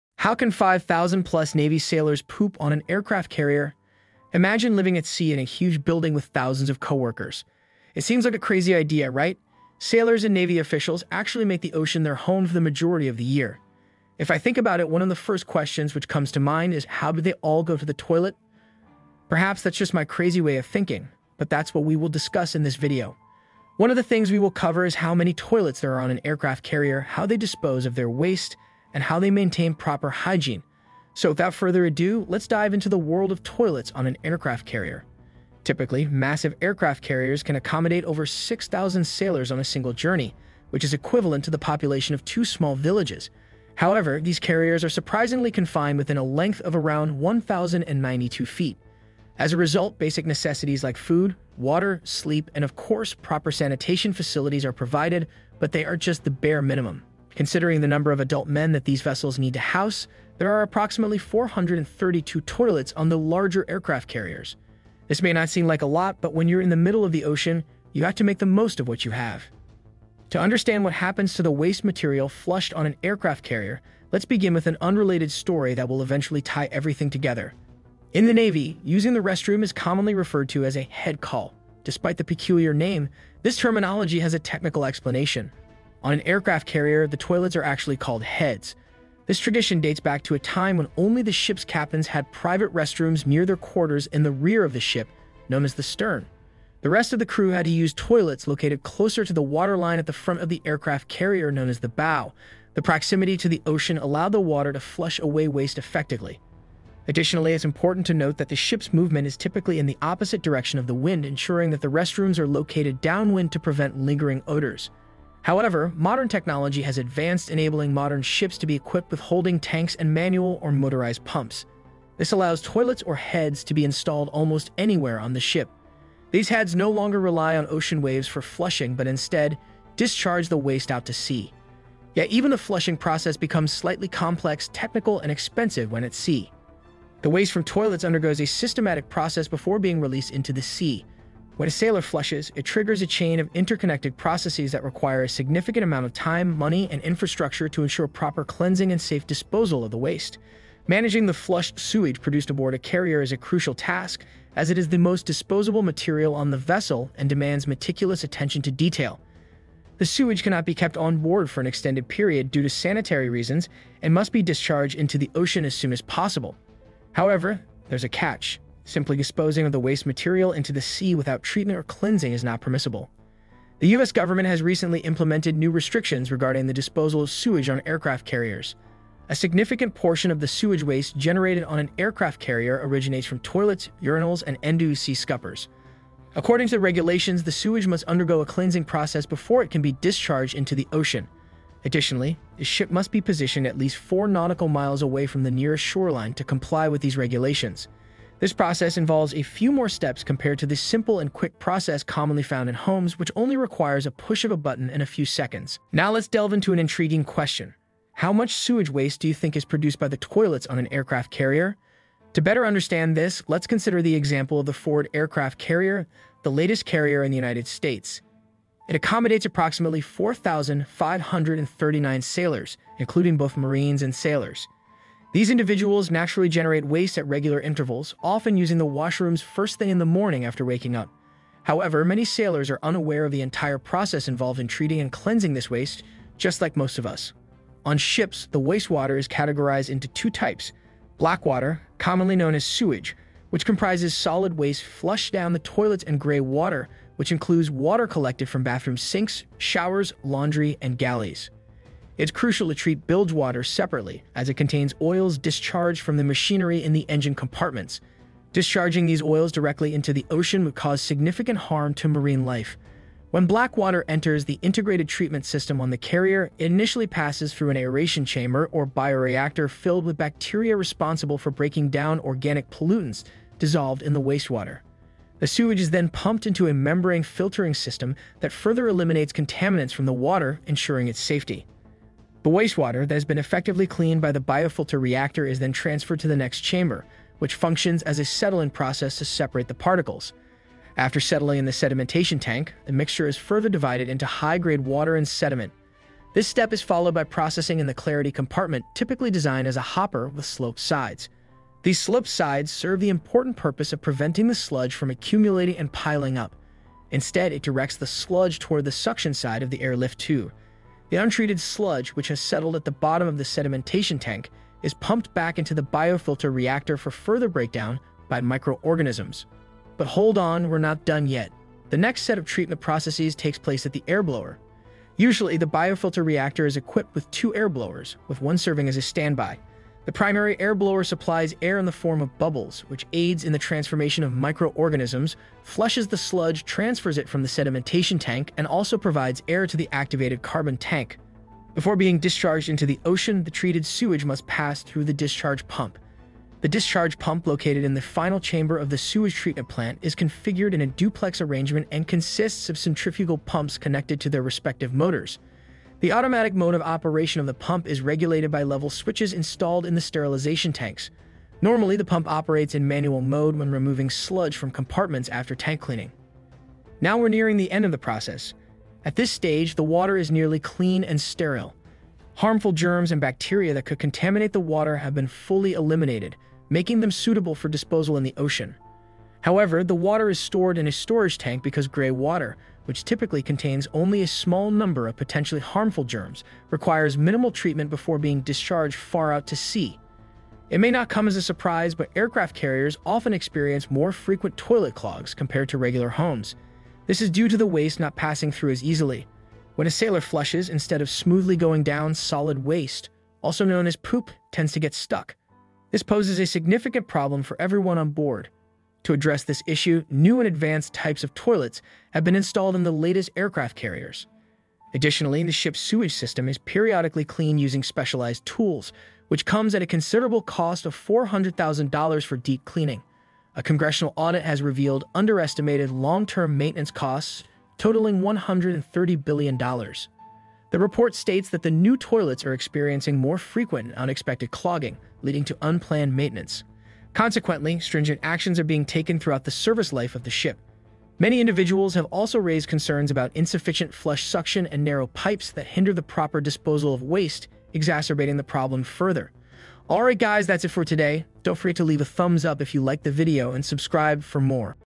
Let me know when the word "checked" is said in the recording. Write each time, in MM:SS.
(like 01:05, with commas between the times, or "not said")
not said.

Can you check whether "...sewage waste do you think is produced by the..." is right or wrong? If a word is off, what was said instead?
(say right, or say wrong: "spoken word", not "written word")
right.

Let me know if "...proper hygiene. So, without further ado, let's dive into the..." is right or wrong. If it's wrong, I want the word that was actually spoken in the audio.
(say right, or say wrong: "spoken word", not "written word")
right.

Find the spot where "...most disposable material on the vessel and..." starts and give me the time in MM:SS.
02:34.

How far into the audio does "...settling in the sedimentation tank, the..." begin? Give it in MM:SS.
04:51.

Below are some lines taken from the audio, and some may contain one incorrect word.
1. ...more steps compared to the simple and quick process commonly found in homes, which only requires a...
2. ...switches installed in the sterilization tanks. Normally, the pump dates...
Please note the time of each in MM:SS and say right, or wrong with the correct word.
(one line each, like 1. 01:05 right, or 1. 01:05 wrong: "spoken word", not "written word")
1. 03:19 right
2. 05:58 wrong: "operates", not "dates".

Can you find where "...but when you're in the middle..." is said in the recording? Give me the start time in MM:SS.
01:06.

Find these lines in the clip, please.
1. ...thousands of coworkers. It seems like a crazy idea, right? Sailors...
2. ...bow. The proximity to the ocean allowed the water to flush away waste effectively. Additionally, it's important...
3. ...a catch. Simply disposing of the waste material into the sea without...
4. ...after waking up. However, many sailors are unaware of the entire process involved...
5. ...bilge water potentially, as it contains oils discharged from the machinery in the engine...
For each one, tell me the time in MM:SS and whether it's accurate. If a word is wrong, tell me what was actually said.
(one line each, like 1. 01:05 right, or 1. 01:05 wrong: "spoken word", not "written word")
1. 00:06 right
2. 01:41 right
3. 02:48 right
4. 03:50 right
5. 04:13 wrong: "separately", not "potentially".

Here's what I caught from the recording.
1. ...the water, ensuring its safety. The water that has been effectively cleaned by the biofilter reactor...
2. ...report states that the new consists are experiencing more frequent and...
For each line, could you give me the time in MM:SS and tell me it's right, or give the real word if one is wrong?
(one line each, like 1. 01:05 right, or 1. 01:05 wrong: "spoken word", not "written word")
1. 04:40 wrong: "wastewater", not "water"
2. 07:10 wrong: "toilets", not "consists".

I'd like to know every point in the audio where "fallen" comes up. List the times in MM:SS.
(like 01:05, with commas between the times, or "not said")
not said.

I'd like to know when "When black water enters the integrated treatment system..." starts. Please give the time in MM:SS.
04:23.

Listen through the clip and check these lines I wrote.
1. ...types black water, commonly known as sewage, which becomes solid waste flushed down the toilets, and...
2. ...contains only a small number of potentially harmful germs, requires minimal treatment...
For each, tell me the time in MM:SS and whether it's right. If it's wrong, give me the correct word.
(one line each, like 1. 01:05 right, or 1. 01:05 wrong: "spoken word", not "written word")
1. 04:00 wrong: "comprises", not "becomes"
2. 06:23 right.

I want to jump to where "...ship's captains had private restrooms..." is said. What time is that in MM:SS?
01:31.